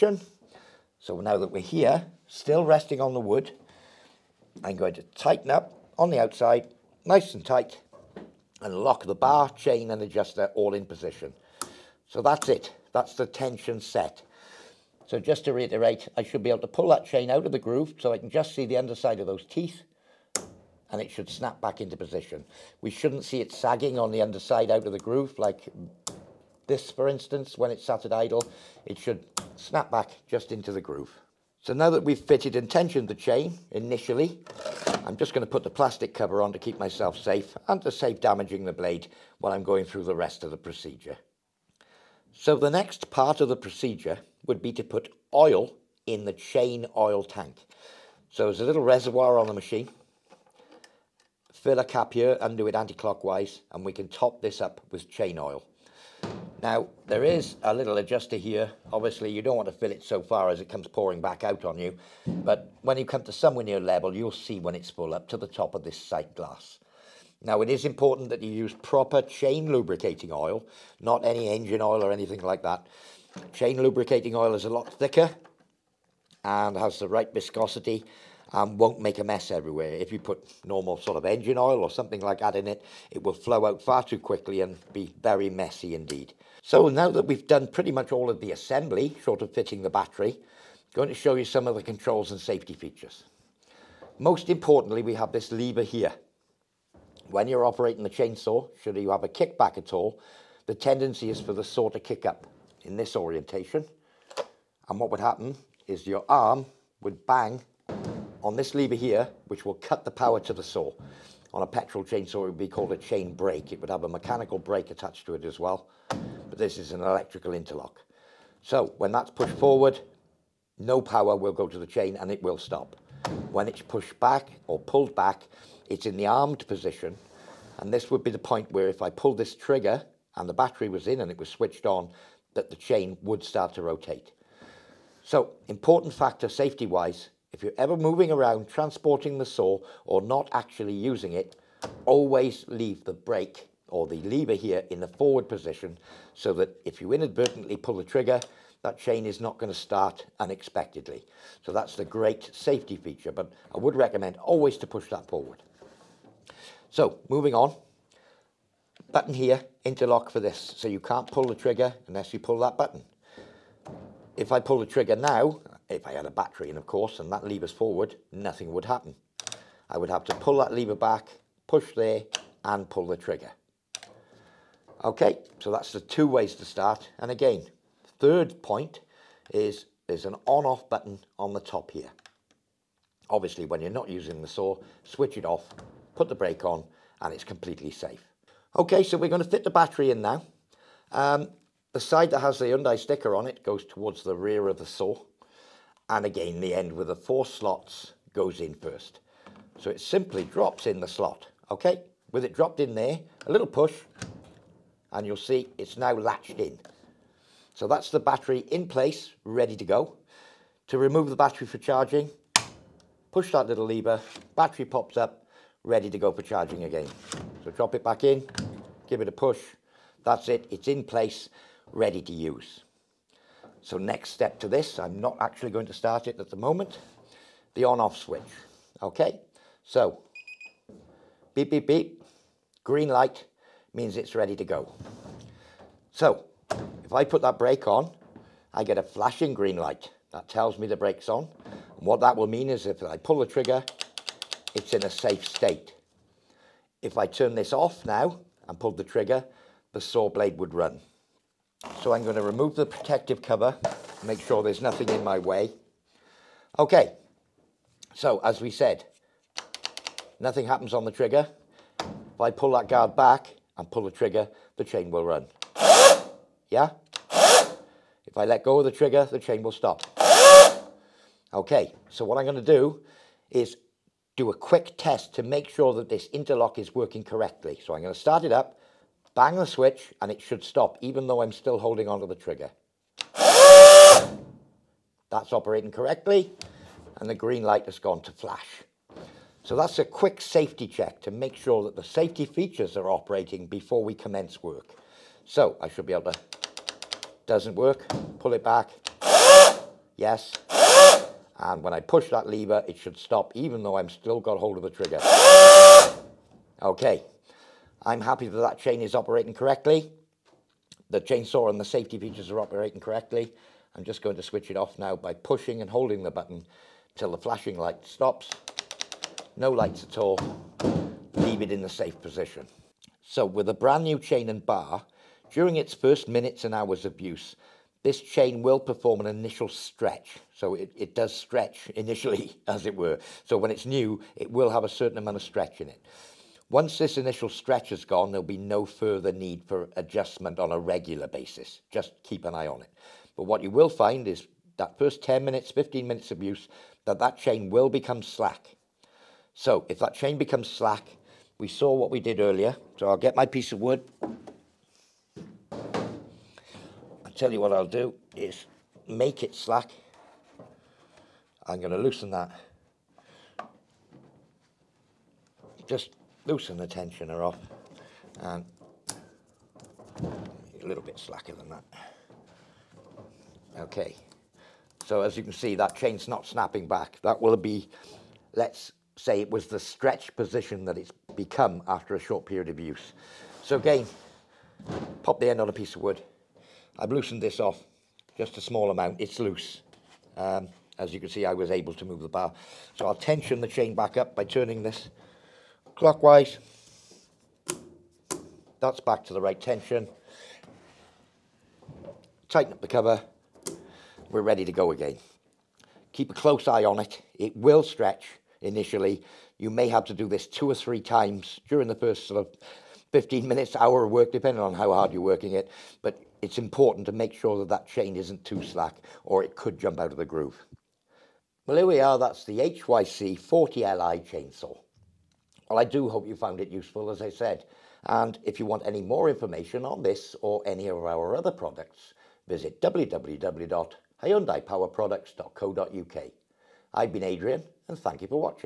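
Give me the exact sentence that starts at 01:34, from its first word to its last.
Most importantly, we have this lever here.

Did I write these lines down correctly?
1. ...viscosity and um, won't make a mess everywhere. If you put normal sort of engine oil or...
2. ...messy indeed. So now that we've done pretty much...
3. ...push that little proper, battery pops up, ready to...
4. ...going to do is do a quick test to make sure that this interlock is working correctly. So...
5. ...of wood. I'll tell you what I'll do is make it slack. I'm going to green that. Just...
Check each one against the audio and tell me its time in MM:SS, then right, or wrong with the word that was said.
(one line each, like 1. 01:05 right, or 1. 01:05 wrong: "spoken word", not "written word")
1. 01:17 right
2. 01:25 right
3. 03:33 wrong: "lever", not "proper"
4. 04:32 right
5. 05:53 wrong: "loosen", not "green".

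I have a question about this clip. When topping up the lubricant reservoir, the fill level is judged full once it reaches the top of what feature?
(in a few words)
Sight glass.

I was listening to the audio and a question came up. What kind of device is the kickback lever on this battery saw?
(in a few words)
Electrical interlock.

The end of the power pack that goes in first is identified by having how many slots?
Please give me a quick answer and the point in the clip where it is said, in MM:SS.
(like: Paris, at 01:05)
4, at 03:17.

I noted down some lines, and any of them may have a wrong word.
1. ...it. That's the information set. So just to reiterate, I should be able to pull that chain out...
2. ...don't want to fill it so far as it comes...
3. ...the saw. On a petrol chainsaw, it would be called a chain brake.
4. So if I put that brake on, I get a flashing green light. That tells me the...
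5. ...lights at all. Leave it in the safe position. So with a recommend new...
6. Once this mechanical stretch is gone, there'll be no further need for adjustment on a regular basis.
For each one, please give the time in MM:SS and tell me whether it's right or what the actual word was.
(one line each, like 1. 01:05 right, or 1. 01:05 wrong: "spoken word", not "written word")
1. 00:12 wrong: "tension", not "information"
2. 00:59 right
3. 01:50 right
4. 03:56 right
5. 05:19 wrong: "brand", not "recommend"
6. 05:36 wrong: "initial", not "mechanical".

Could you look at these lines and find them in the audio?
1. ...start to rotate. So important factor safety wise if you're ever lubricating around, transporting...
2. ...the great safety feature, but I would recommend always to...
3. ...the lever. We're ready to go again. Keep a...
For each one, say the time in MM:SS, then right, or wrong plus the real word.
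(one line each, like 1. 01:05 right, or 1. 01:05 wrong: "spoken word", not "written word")
1. 02:13 wrong: "moving", not "lubricating"
2. 02:31 right
3. 06:42 wrong: "cover", not "lever".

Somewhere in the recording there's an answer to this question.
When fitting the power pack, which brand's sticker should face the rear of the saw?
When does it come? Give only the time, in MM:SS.
03:12.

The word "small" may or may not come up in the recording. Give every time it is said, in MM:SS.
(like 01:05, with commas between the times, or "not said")
06:28.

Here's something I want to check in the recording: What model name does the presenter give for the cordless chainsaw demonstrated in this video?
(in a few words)
HYC 40LI.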